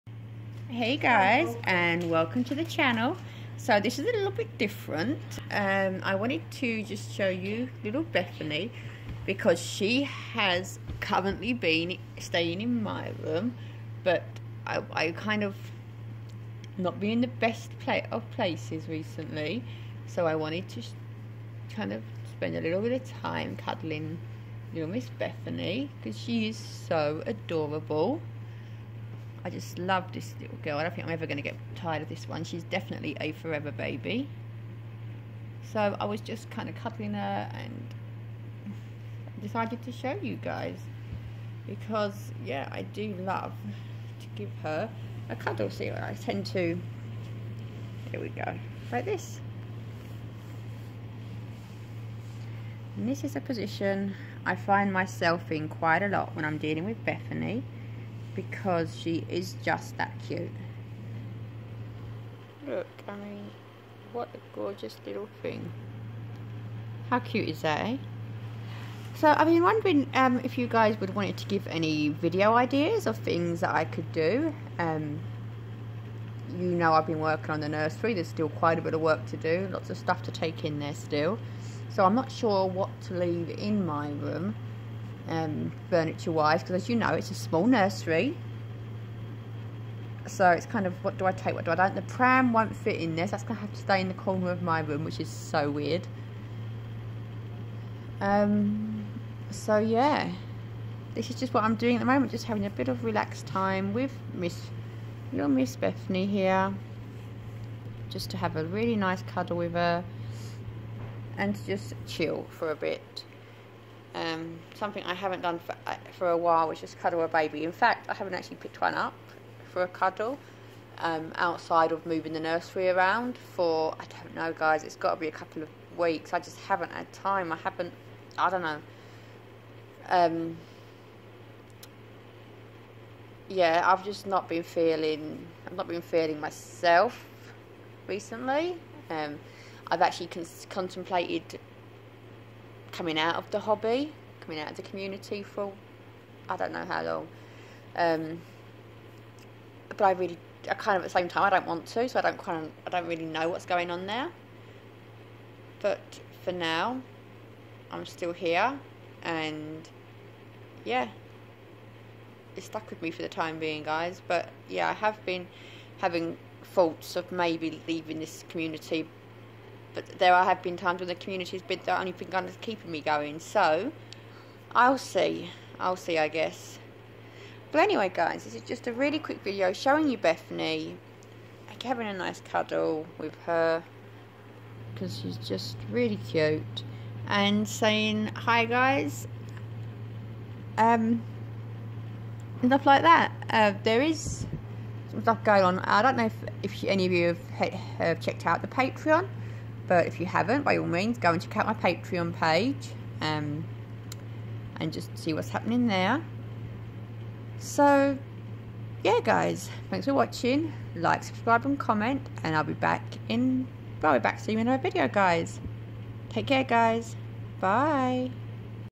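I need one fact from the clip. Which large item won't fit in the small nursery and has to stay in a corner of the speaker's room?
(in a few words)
The pram.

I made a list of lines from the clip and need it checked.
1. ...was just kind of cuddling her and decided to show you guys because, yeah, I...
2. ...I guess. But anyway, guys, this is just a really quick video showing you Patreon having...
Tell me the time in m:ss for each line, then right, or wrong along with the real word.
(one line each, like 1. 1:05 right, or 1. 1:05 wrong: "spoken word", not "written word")
1. 0:36 right
2. 2:56 wrong: "Bethany", not "Patreon".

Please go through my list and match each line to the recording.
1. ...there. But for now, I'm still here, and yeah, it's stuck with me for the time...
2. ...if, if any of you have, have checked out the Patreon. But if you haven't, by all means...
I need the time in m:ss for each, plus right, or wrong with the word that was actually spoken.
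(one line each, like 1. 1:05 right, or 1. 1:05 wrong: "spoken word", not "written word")
1. 2:34 right
2. 3:16 right.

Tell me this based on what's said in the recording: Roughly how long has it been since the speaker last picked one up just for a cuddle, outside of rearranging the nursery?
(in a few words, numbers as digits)
A couple of weeks.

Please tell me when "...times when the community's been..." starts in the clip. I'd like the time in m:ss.
2:50.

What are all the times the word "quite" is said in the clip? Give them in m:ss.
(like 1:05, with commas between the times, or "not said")
0:55, 1:18.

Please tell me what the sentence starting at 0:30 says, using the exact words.
I don't think I'm ever going to get tired of this one.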